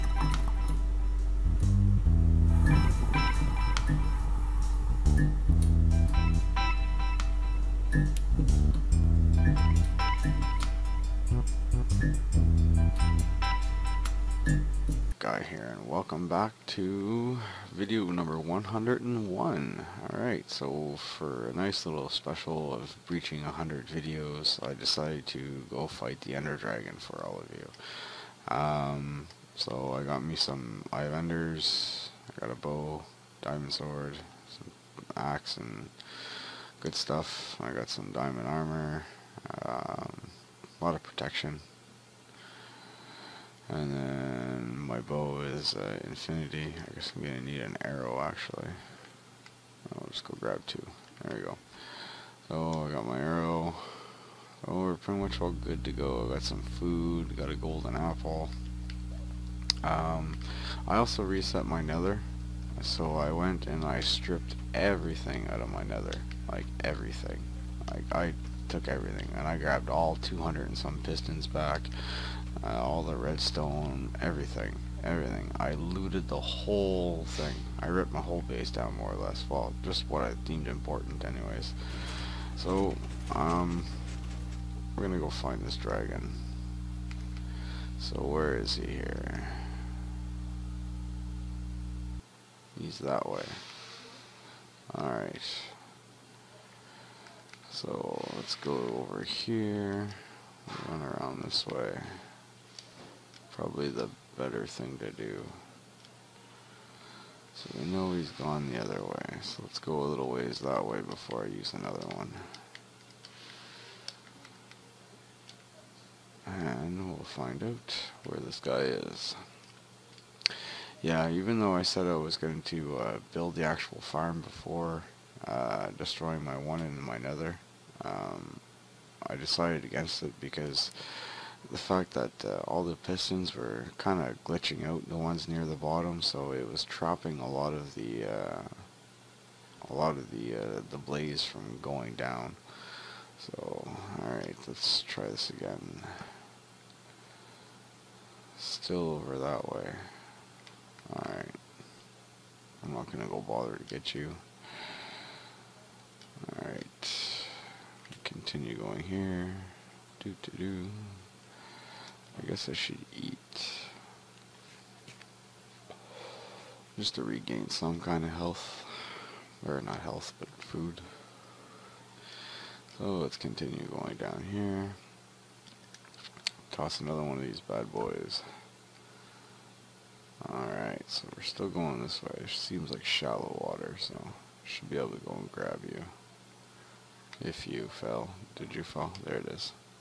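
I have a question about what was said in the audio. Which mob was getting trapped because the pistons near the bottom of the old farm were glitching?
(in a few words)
Blaze.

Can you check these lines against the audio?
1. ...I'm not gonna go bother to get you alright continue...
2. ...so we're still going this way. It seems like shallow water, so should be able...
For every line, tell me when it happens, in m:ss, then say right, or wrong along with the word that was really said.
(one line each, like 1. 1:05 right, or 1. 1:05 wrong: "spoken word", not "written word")
1. 2:32 right
2. 3:01 right.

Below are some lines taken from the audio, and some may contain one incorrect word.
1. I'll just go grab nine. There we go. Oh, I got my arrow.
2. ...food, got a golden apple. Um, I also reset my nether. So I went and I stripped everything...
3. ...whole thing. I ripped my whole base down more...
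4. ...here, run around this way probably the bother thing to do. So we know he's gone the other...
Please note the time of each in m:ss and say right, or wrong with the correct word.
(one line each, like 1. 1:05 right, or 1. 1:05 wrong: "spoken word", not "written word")
1. 0:49 wrong: "two", not "nine"
2. 0:56 right
3. 1:16 right
4. 1:39 wrong: "better", not "bother".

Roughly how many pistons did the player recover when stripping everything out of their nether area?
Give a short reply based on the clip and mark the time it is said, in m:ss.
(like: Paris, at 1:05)
200, at 1:10.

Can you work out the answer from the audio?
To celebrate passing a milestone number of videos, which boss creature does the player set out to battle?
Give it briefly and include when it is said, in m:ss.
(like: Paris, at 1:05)
Ender Dragon, at 0:26.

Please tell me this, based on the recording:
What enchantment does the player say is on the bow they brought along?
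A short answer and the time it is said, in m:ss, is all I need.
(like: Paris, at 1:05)
Infinity, at 0:46.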